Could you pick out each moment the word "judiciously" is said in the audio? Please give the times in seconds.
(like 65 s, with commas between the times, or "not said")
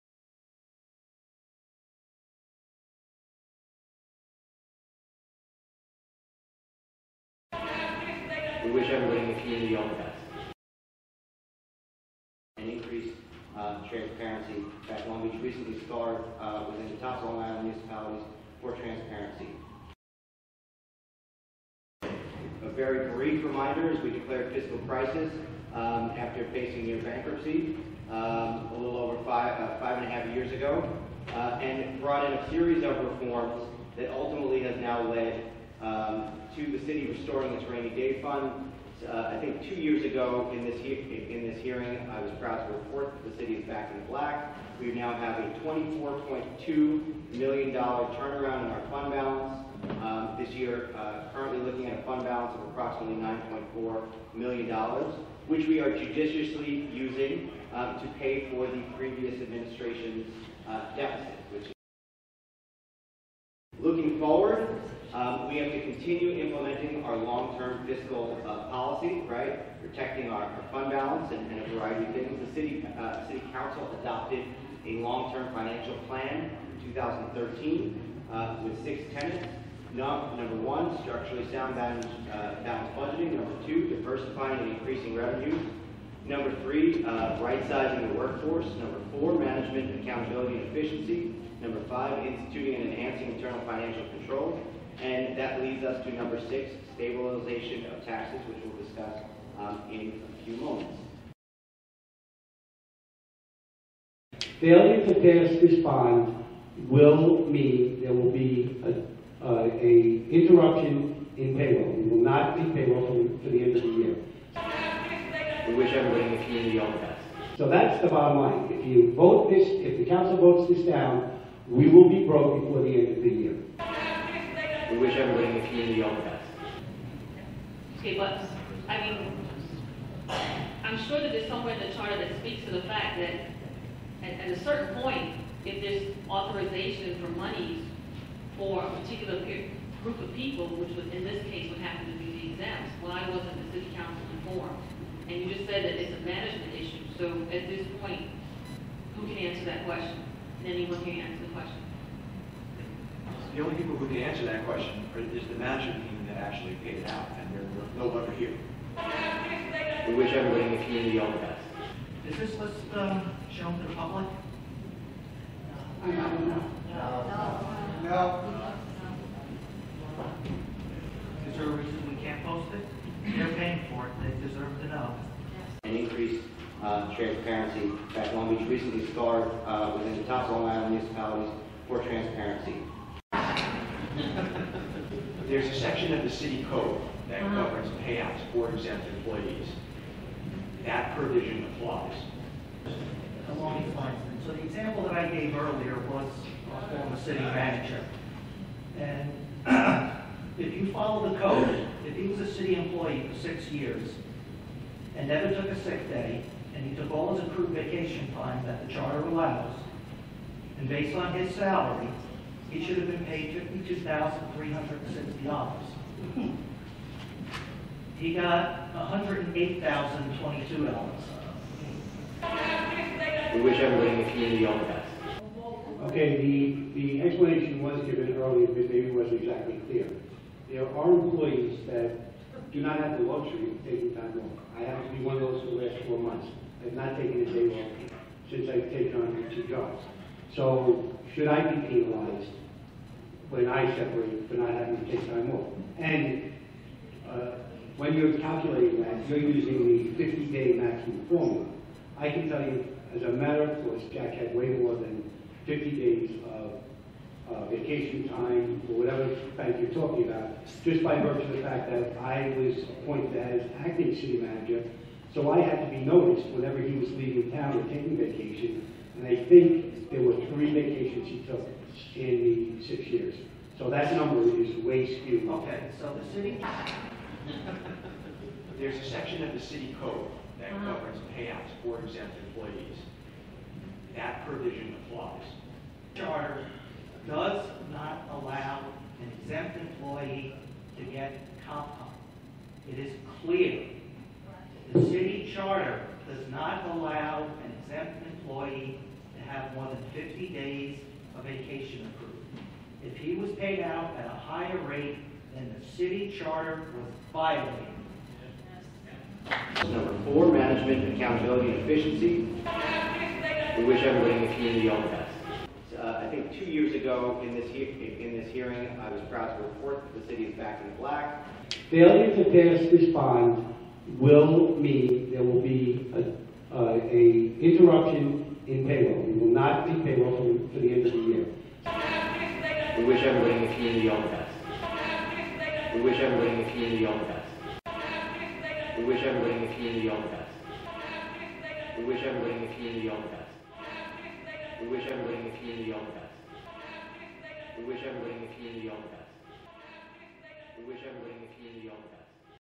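55 s.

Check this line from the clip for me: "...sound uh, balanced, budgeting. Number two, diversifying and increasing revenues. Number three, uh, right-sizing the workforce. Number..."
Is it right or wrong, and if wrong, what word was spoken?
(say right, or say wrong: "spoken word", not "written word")
right.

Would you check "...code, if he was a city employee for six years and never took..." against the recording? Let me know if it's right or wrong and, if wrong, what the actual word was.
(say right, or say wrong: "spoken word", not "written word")
right.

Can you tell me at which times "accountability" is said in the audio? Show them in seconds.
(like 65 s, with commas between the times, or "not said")
90 s, 311 s.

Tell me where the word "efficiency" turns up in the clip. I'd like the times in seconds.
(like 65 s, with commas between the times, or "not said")
90 s, 311 s.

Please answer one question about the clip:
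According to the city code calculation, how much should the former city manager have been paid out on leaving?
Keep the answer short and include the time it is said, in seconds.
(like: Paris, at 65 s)
$52,360, at 213 s.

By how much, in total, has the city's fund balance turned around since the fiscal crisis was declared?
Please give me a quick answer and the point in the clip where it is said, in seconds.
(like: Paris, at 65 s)
$24.2 million, at 45 s.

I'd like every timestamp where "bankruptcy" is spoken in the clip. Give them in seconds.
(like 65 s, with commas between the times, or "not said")
27 s.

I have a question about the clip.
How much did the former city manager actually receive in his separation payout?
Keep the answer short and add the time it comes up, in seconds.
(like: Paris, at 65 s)
$108,022, at 218 s.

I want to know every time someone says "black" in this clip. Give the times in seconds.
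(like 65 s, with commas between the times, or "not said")
44 s, 320 s.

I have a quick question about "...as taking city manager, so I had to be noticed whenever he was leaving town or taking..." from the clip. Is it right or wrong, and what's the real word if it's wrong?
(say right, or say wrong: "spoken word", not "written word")
wrong: "acting", not "taking".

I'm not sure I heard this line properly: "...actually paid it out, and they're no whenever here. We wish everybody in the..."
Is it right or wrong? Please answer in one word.
wrong.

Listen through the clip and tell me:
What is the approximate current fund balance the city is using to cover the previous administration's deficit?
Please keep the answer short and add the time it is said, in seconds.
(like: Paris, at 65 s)
$9.4 million, at 53 s.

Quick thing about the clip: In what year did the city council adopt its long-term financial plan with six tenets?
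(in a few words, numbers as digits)
2013.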